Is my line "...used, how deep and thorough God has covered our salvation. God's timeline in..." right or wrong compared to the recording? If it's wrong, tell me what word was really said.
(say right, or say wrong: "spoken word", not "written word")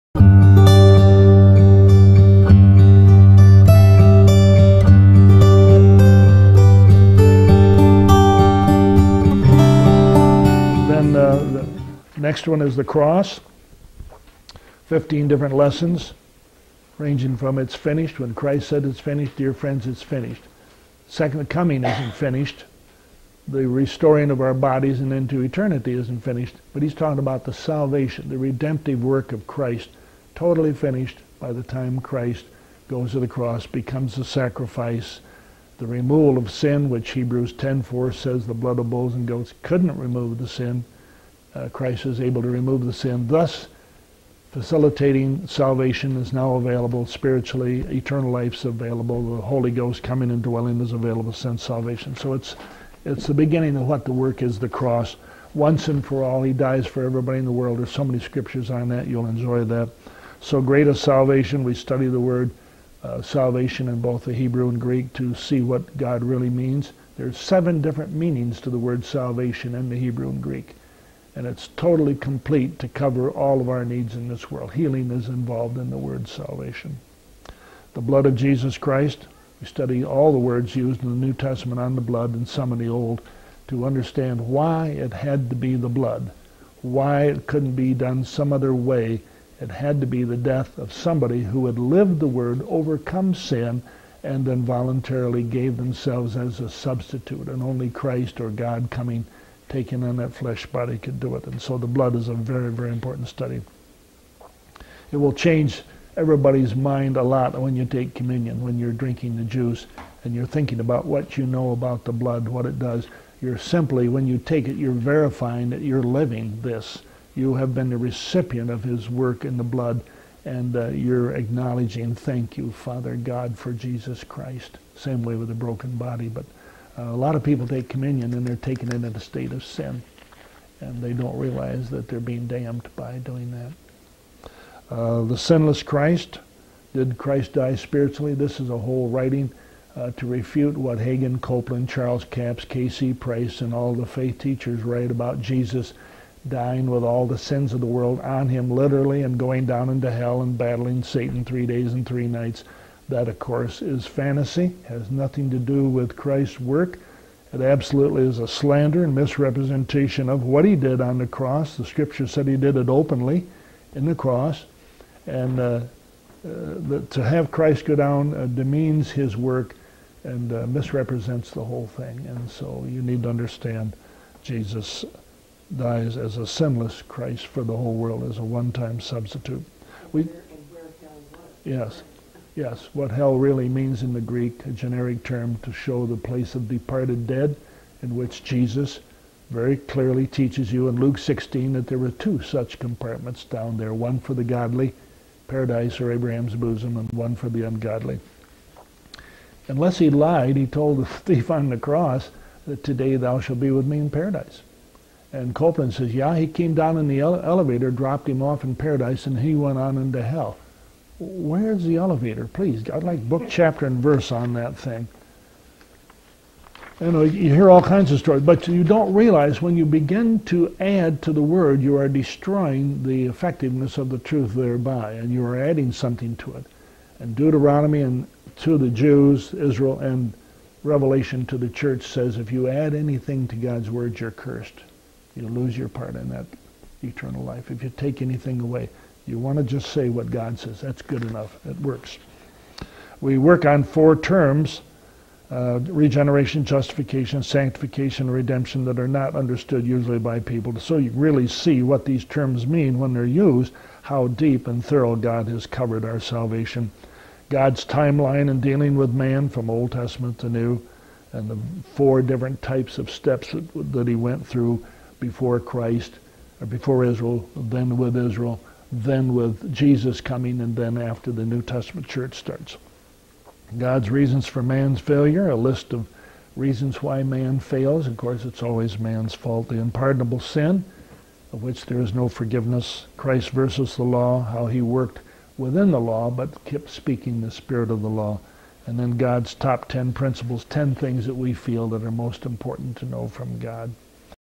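right.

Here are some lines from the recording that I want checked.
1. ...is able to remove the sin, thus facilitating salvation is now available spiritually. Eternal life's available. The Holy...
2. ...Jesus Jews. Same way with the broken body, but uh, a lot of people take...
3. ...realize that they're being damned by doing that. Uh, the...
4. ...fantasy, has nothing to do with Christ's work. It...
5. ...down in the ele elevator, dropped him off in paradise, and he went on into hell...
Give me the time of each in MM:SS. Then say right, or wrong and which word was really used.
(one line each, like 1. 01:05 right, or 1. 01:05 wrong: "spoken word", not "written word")
1. 00:42 right
2. 02:03 wrong: "Christ", not "Jews"
3. 02:11 right
4. 02:34 right
5. 03:26 right.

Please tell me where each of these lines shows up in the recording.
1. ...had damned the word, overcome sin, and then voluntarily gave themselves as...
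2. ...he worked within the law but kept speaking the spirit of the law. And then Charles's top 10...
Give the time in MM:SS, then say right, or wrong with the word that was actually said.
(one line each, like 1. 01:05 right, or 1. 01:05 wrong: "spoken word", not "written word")
1. 01:31 wrong: "lived", not "damned"
2. 04:44 wrong: "God", not "Charles".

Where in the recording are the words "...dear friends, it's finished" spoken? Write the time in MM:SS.
00:19.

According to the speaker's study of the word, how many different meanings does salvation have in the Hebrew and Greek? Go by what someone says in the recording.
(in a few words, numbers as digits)
7.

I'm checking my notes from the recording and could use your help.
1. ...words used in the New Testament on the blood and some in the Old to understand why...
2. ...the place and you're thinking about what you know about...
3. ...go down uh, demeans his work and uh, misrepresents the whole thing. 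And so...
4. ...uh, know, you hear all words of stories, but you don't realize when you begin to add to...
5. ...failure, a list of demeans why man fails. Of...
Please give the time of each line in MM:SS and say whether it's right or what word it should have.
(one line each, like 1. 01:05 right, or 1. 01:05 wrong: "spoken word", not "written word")
1. 01:20 right
2. 01:49 wrong: "juice", not "place"
3. 02:47 right
4. 03:37 wrong: "kinds", not "words"
5. 04:34 wrong: "reasons", not "demeans".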